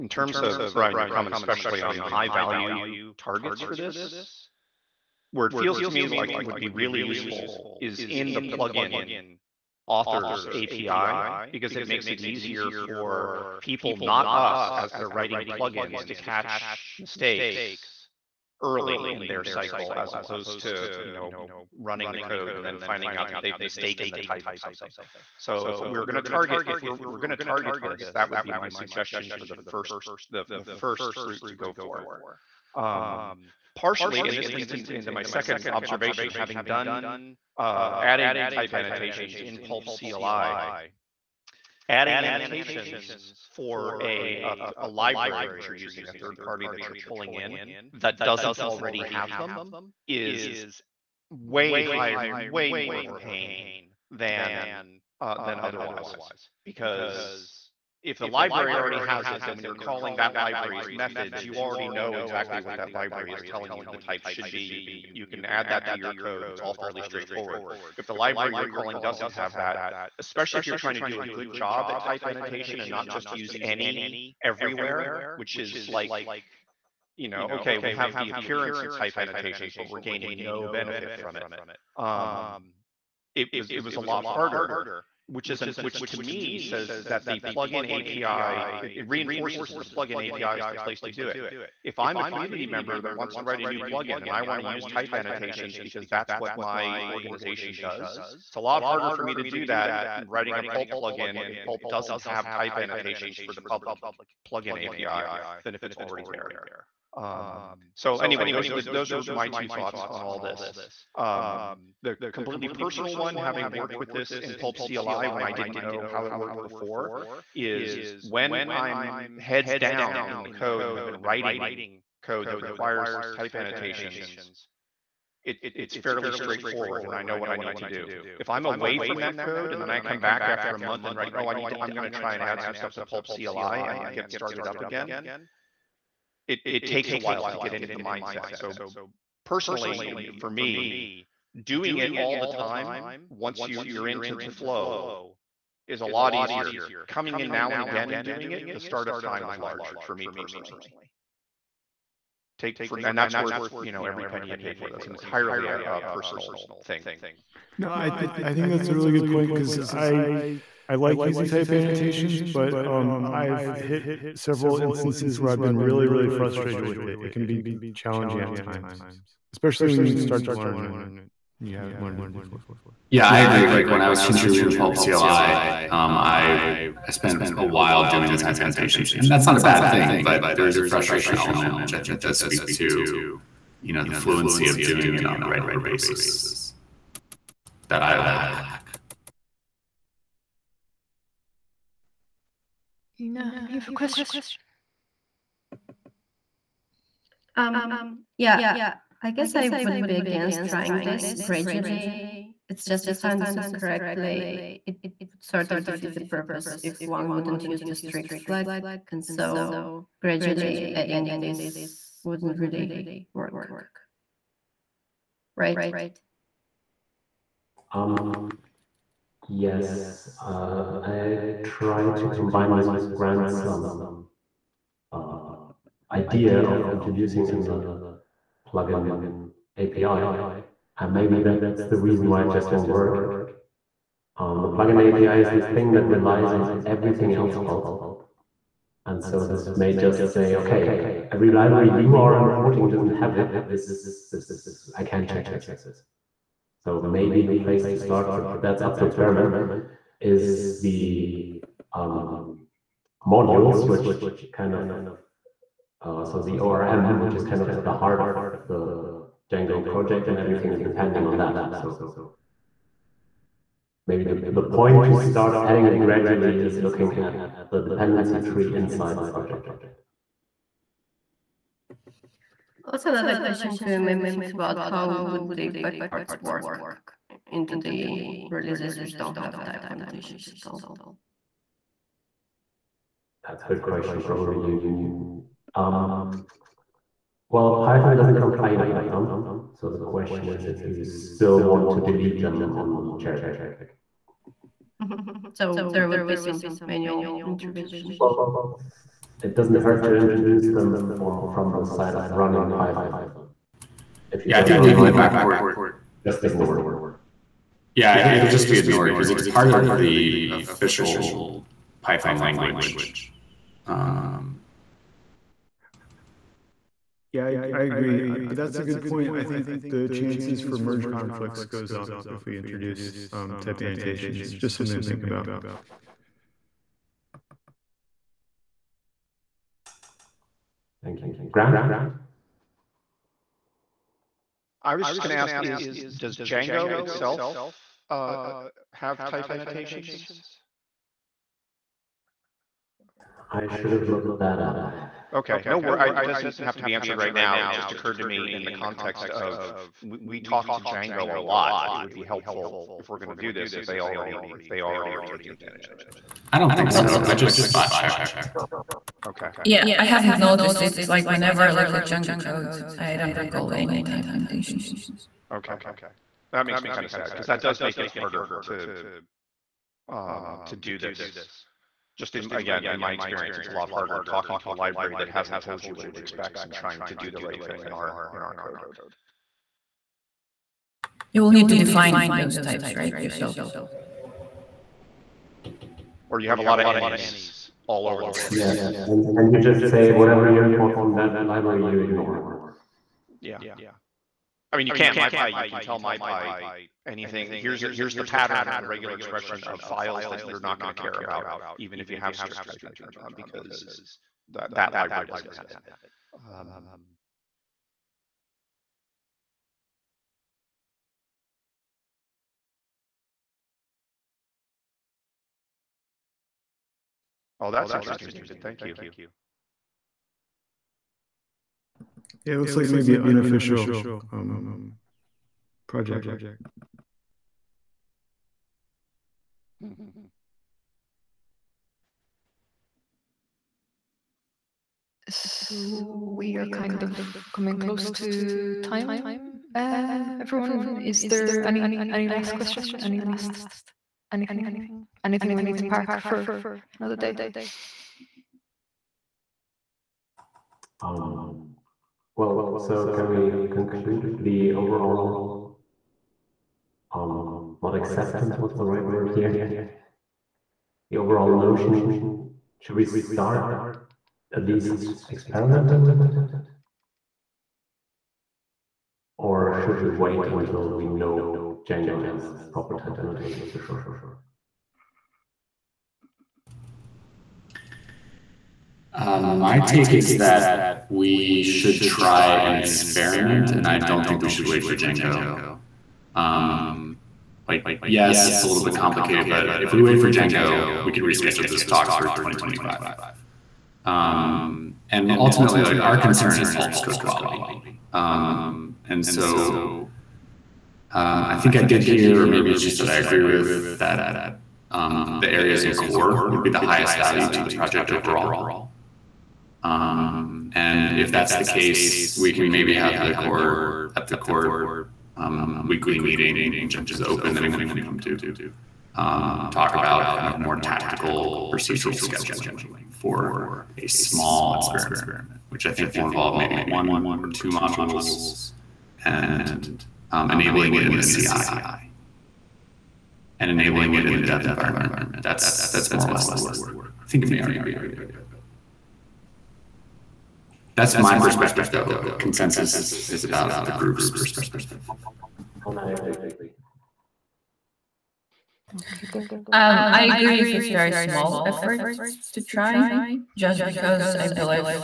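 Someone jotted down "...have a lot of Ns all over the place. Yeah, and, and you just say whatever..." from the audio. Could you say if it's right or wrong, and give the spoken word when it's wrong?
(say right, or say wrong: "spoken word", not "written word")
right.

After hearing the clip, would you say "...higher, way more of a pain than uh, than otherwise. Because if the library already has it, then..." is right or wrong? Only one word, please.
right.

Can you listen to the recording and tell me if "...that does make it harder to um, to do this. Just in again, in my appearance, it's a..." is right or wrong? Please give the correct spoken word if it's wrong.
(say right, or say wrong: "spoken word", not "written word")
wrong: "experience", not "appearance".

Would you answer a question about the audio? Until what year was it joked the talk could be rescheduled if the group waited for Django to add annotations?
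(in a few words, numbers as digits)
2025.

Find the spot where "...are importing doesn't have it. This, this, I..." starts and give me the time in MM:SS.
04:02.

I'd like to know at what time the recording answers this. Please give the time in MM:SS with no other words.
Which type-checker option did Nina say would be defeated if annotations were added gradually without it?
03:27.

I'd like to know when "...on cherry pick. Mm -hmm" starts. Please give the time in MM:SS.
04:52.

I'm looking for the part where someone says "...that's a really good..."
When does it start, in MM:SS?
02:38.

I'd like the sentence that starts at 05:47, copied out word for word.
It just occurred to me in the context of we, we talk to Django a lot.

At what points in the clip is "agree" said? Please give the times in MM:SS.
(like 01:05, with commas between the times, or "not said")
02:53, 05:17, 08:23, 09:06, 09:10.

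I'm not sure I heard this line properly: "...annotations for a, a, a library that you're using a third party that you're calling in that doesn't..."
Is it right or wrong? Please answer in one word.
wrong.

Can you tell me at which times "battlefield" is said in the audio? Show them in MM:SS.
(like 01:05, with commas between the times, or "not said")
not said.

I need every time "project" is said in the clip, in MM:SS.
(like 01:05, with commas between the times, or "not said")
04:19, 04:29, 07:05, 08:27.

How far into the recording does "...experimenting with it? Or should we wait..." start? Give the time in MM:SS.
07:45.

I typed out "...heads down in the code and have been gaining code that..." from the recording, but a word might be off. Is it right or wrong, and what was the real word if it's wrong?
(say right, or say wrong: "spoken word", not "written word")
wrong: "writing", not "gaining".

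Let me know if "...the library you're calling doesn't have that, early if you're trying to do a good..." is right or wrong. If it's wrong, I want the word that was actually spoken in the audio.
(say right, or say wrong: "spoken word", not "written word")
wrong: "especially", not "early".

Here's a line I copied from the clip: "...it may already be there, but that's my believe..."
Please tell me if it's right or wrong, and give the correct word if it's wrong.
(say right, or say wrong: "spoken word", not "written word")
wrong: "perspective", not "believe".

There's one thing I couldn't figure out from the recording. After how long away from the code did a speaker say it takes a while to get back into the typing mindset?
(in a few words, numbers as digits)
a month.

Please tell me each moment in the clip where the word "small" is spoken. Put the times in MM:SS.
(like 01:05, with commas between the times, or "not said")
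08:44, 09:11.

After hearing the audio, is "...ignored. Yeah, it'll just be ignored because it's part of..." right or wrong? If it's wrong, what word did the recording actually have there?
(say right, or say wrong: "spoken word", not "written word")
right.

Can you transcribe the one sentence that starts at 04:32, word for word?
What's another question to maybe think about?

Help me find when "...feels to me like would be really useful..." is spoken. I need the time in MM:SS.
00:05.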